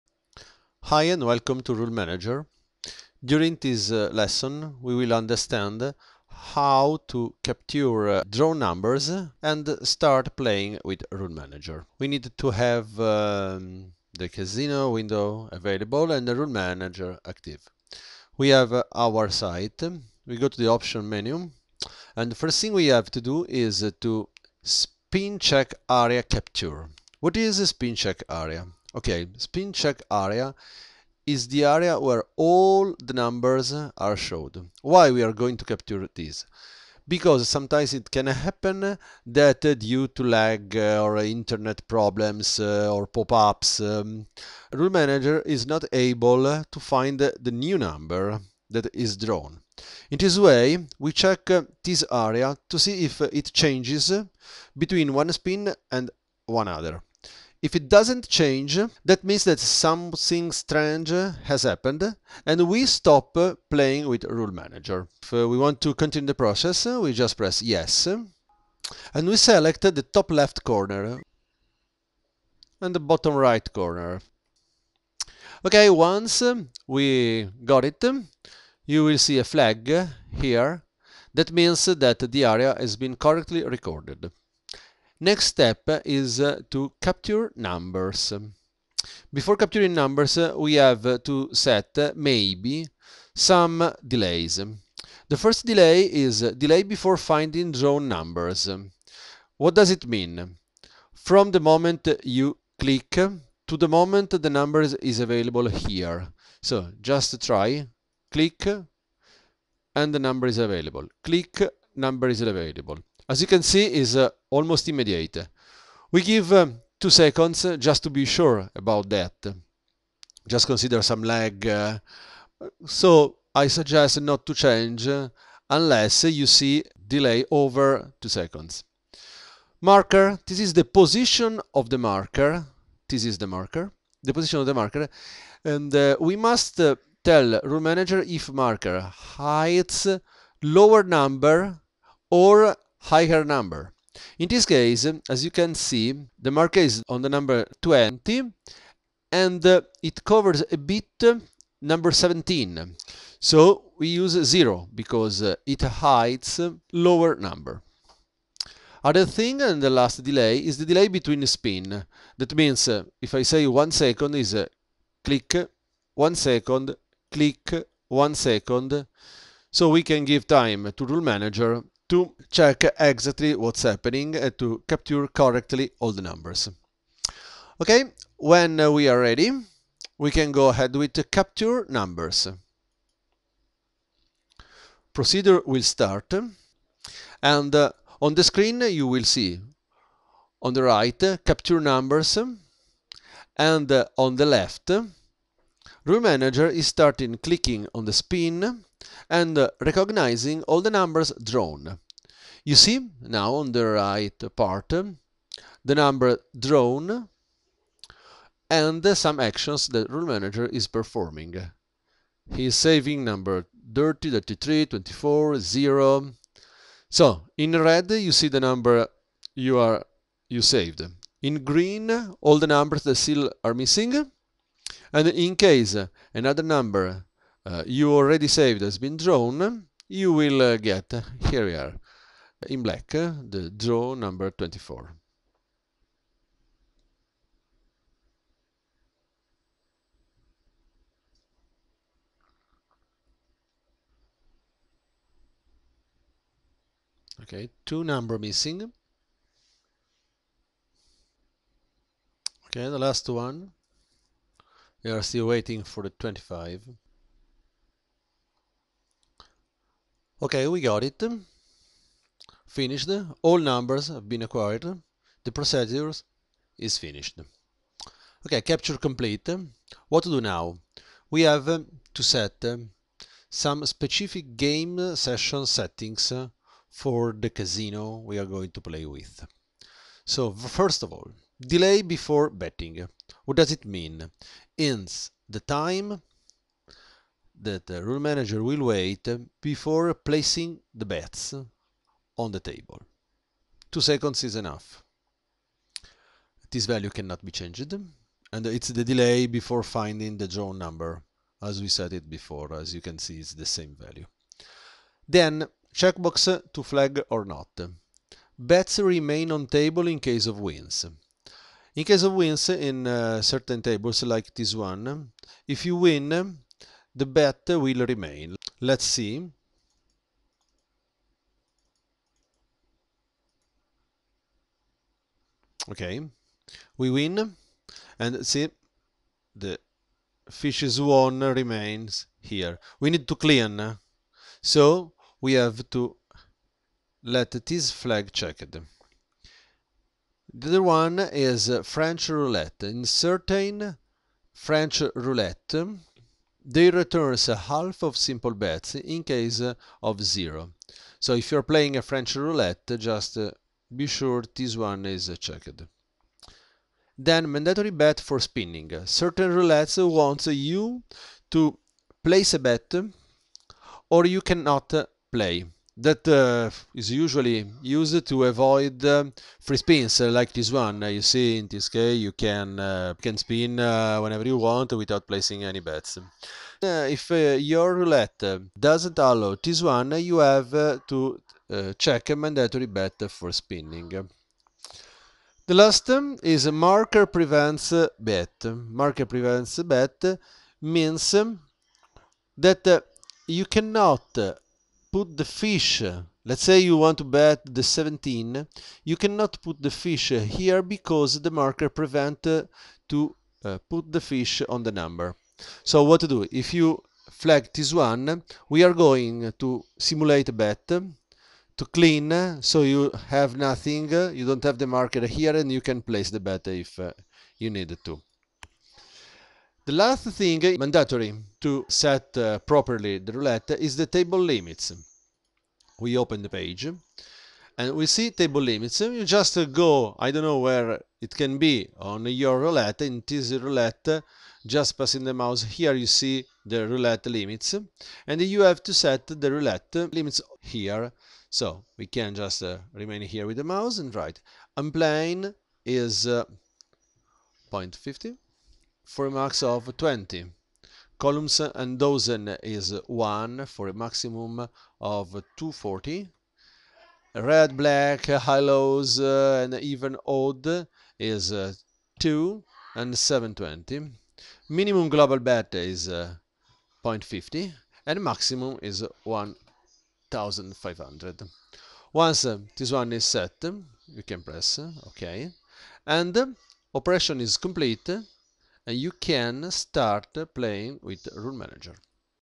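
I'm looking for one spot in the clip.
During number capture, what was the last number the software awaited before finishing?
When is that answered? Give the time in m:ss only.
4:16.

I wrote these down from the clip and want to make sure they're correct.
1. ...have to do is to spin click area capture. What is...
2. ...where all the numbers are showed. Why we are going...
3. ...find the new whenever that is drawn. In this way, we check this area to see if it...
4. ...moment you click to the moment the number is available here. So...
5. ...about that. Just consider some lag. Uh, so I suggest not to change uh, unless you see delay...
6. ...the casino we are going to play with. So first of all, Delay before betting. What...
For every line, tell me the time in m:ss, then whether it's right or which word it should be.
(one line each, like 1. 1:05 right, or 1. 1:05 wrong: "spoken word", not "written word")
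1. 0:22 wrong: "check", not "click"
2. 0:31 right
3. 0:46 wrong: "number", not "whenever"
4. 1:41 right
5. 1:58 right
6. 4:37 right.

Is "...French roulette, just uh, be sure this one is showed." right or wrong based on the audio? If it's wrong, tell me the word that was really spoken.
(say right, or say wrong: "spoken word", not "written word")
wrong: "checked", not "showed".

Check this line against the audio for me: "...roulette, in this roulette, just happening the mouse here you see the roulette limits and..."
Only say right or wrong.
wrong.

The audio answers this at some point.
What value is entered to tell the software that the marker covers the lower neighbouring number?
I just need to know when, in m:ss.
2:33.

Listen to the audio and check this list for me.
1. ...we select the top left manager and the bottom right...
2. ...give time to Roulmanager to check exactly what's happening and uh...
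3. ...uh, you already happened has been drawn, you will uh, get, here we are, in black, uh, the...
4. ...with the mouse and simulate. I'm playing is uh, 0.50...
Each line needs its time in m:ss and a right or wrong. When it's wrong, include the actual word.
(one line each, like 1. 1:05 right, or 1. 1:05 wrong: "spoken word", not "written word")
1. 1:09 wrong: "corner", not "manager"
2. 2:50 right
3. 3:47 wrong: "saved", not "happened"
4. 7:23 wrong: "write", not "simulate".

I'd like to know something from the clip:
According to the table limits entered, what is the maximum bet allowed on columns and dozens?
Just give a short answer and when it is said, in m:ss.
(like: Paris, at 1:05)
240, at 7:35.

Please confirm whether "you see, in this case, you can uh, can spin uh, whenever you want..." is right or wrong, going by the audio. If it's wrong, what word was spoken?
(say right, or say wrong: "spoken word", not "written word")
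right.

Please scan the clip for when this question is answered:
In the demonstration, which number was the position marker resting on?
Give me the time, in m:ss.
2:27.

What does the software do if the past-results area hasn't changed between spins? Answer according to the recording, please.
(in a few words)
Stop playing.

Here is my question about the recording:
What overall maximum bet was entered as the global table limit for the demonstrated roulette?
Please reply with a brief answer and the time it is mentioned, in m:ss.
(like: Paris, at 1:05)
1500, at 7:49.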